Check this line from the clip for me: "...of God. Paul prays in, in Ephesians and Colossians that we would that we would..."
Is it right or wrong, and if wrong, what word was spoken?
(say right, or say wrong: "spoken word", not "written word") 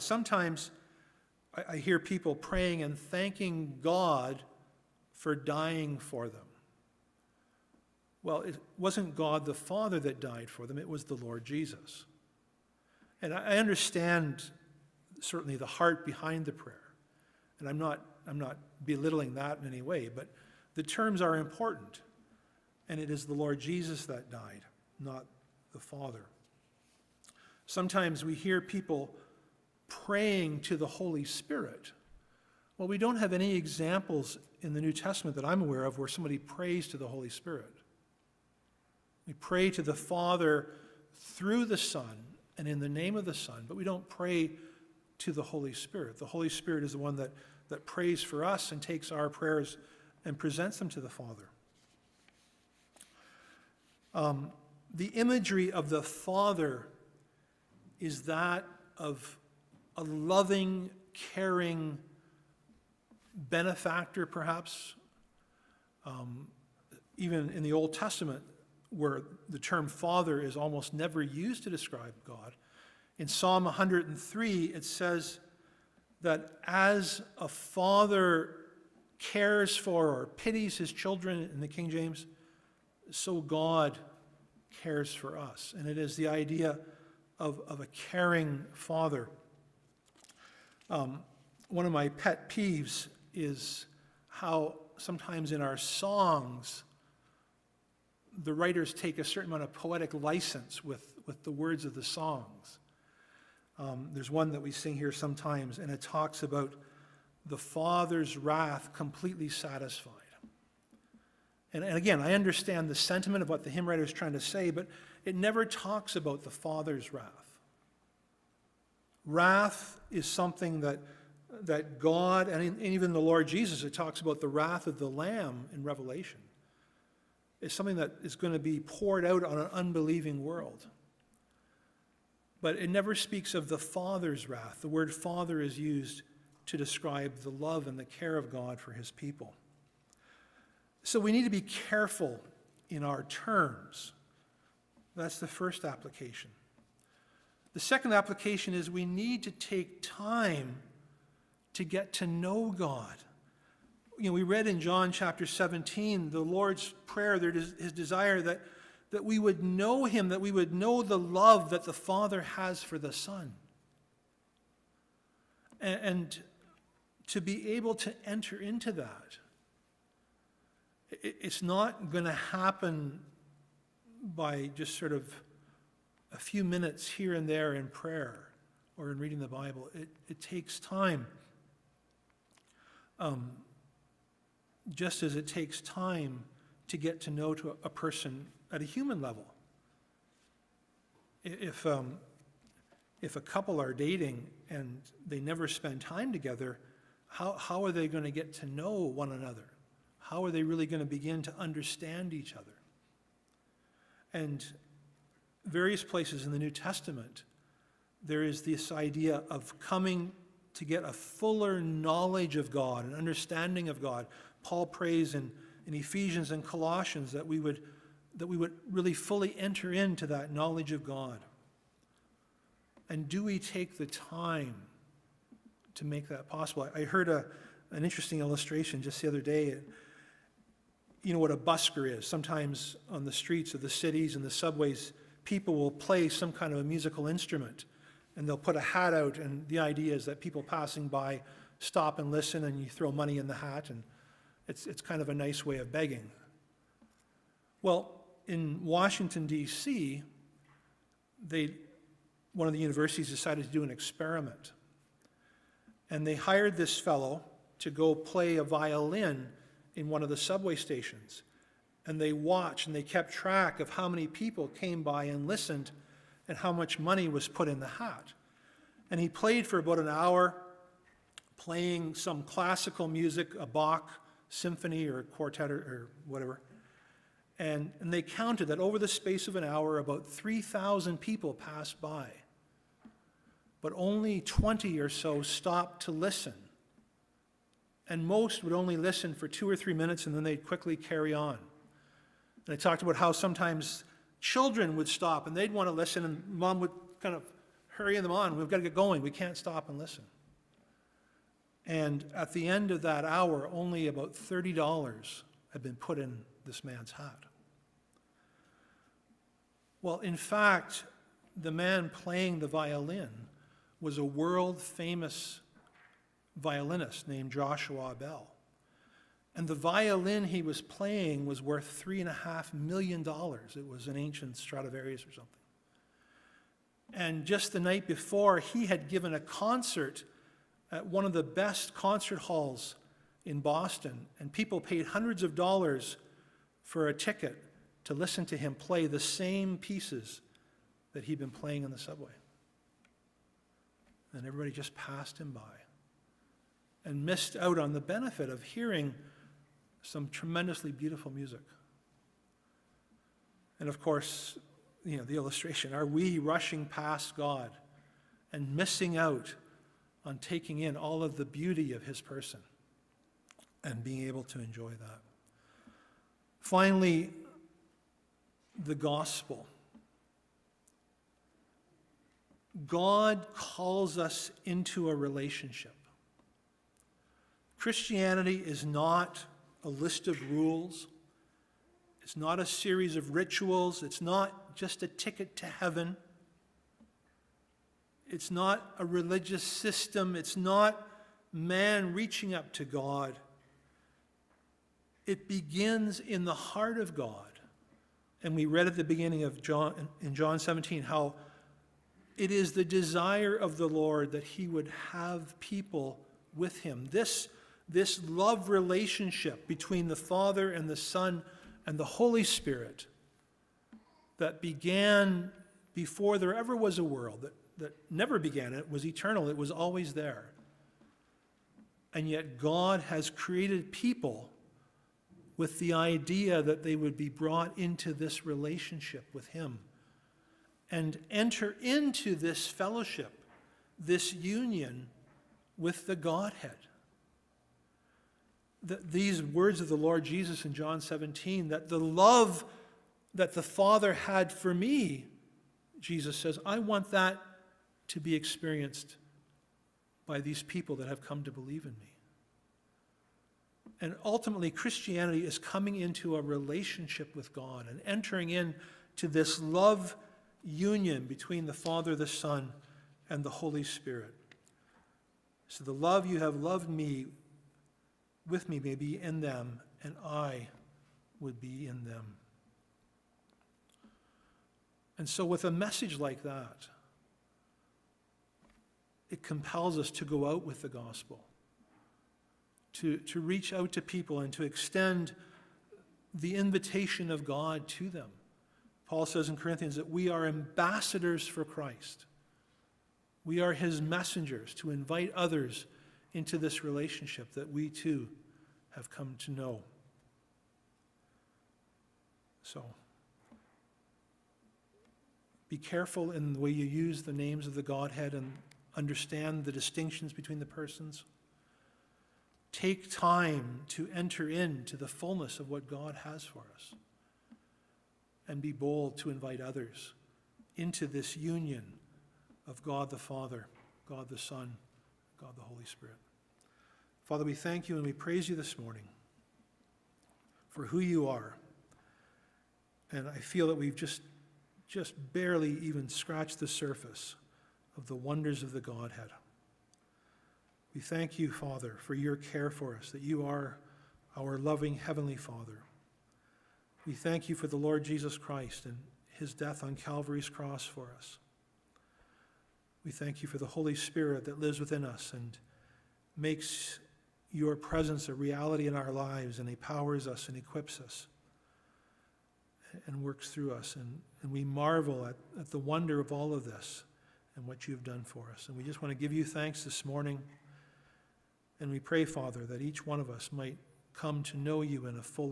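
right.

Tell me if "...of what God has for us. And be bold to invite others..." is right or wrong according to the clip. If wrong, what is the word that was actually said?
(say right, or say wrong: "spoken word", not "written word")
right.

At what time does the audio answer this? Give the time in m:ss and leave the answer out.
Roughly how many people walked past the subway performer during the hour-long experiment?
4:40.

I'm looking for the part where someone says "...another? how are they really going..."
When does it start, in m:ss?
3:19.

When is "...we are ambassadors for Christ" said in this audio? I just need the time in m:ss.
8:10.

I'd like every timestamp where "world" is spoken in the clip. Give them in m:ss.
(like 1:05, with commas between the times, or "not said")
2:10, 5:14, 6:57.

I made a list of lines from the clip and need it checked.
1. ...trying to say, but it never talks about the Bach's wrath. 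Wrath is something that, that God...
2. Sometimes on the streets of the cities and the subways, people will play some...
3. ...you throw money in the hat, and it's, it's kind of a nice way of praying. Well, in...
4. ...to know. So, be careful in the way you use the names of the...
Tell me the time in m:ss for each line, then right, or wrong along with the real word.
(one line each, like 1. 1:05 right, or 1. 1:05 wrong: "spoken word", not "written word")
1. 1:54 wrong: "Father", not "Bach"
2. 3:52 right
3. 4:02 wrong: "begging", not "praying"
4. 8:19 right.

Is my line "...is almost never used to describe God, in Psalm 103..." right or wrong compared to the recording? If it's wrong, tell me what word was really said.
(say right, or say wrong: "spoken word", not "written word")
right.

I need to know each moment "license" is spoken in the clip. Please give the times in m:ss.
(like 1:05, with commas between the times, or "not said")
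1:40.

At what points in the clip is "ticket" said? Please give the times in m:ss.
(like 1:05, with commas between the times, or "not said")
5:37, 6:25.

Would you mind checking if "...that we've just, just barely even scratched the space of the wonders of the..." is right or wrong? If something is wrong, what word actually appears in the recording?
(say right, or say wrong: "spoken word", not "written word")
wrong: "surface", not "space".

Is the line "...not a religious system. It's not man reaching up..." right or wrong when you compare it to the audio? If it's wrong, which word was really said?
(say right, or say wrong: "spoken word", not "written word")
right.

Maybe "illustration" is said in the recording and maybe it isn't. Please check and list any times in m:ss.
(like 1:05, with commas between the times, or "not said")
3:48, 5:55.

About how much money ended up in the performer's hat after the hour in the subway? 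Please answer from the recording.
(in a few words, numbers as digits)
$30.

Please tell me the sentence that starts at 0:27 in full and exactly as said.
Sometimes we hear people praying to the Holy Spirit.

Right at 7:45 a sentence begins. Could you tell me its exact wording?
So the love you have loved me with me may be in them, and I would be in them.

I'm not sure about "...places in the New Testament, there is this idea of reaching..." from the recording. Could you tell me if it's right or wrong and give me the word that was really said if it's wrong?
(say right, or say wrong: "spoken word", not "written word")
wrong: "coming", not "reaching".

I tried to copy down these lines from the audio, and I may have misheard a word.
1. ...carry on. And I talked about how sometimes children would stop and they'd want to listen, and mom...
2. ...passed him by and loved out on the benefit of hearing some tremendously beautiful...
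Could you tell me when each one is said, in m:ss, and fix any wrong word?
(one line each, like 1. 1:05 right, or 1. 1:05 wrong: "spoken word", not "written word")
1. 4:50 right
2. 5:44 wrong: "missed", not "loved".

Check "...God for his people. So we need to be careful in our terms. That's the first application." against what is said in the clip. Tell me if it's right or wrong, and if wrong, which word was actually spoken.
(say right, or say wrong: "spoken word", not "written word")
right.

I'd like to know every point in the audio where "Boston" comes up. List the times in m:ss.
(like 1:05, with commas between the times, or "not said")
5:33.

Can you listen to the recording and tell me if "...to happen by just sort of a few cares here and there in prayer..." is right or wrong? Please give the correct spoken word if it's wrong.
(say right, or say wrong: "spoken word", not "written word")
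wrong: "minutes", not "cares".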